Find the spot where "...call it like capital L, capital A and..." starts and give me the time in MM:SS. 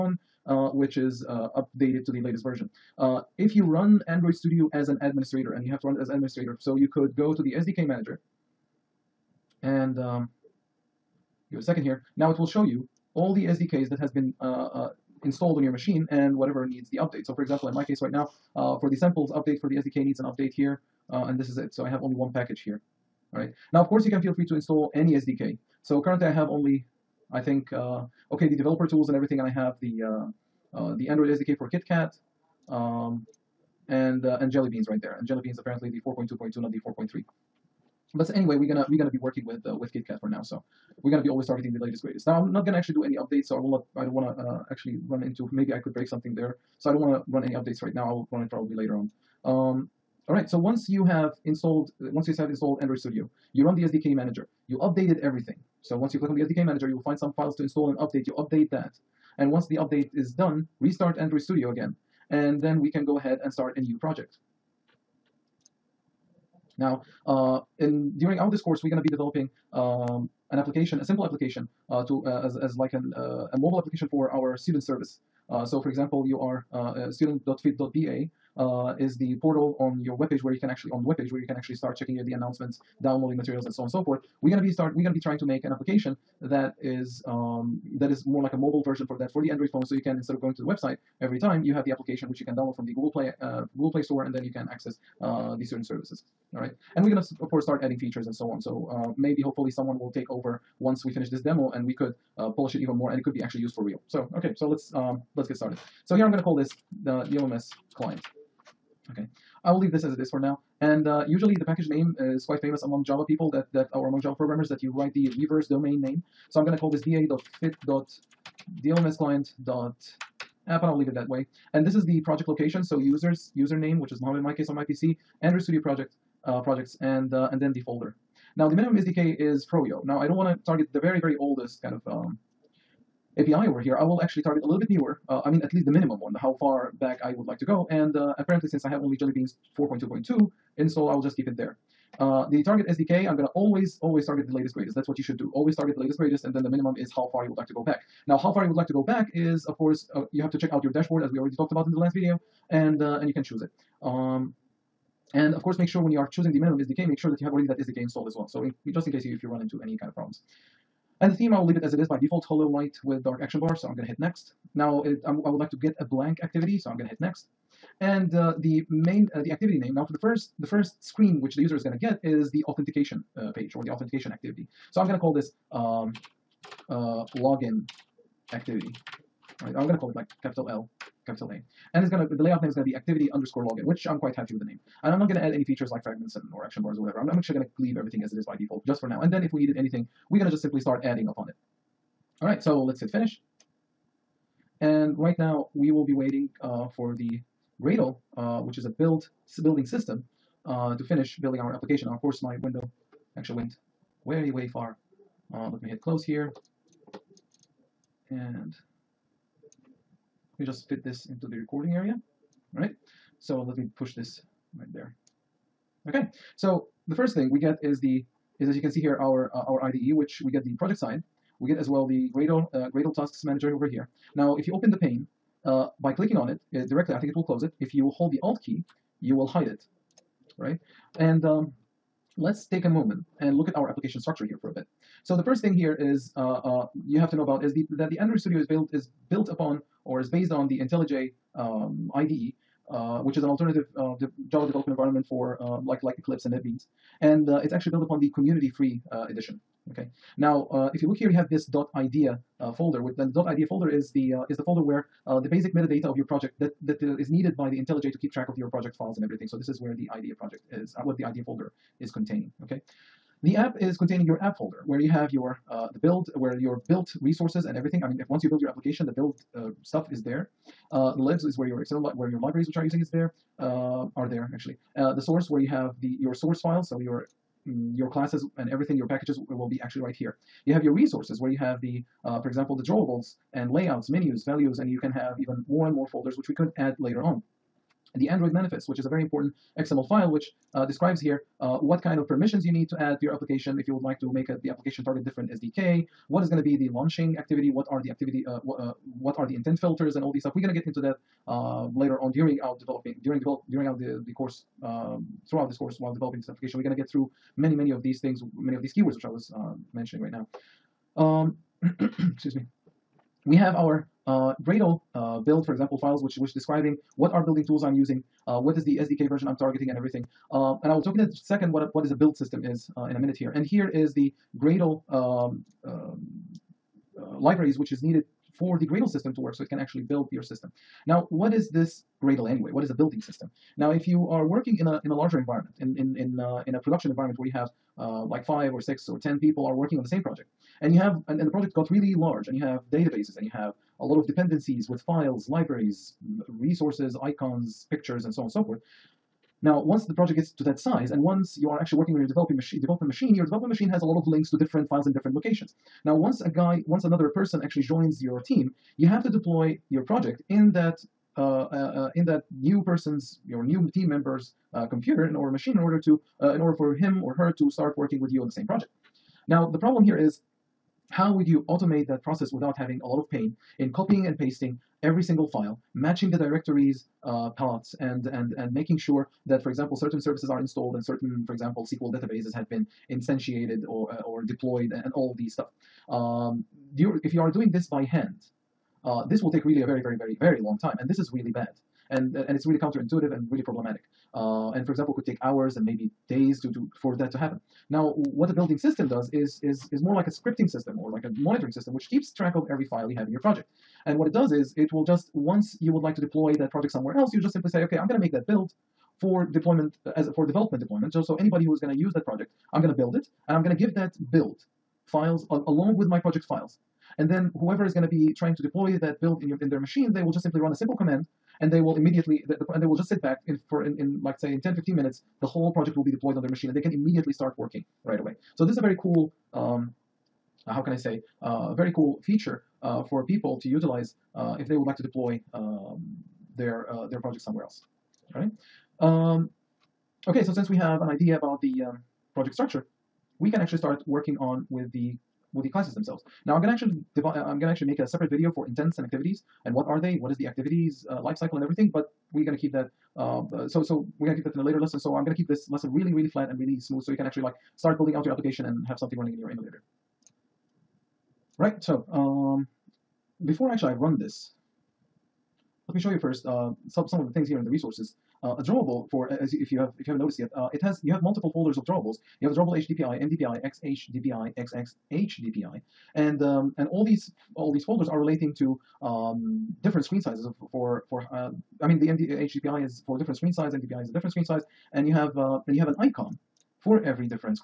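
02:59.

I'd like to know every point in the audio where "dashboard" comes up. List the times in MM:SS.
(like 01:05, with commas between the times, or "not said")
02:30.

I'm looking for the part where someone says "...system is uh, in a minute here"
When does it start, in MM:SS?
05:22.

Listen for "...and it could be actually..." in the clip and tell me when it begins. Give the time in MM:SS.
01:43.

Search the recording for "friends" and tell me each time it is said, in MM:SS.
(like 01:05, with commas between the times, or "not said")
not said.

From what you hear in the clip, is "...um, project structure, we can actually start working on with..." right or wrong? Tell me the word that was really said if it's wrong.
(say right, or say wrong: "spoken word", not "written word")
right.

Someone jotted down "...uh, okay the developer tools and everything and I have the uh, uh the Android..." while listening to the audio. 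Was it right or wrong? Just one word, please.
right.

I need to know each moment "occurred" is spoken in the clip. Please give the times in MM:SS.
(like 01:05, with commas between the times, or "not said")
not said.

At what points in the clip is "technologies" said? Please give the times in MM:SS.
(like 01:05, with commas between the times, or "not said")
not said.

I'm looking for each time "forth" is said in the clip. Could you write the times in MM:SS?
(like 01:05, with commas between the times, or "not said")
01:24, 05:48.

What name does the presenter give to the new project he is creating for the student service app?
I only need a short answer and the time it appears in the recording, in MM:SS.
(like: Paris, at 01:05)
DLMS client, at 01:47.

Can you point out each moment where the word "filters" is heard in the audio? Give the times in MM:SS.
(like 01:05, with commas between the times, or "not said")
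04:59.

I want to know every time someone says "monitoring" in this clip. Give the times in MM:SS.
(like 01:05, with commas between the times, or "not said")
06:41.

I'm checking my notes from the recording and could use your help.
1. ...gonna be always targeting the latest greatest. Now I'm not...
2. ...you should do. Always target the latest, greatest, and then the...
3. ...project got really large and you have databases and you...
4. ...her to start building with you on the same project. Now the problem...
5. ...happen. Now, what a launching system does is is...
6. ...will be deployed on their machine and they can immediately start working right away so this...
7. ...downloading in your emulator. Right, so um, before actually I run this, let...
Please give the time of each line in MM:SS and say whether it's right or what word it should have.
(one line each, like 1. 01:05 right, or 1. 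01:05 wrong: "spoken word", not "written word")
1. 00:41 right
2. 02:25 right
3. 05:41 right
4. 06:07 wrong: "working", not "building"
5. 06:37 wrong: "building", not "launching"
6. 07:05 right
7. 07:39 wrong: "running", not "downloading".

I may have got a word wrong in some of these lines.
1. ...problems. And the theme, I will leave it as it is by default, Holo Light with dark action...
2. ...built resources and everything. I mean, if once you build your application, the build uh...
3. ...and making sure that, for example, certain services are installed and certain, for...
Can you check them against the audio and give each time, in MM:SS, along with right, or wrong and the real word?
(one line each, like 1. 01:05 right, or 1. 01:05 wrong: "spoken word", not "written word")
1. 02:40 right
2. 04:26 right
3. 06:18 right.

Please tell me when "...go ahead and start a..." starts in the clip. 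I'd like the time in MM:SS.
01:03.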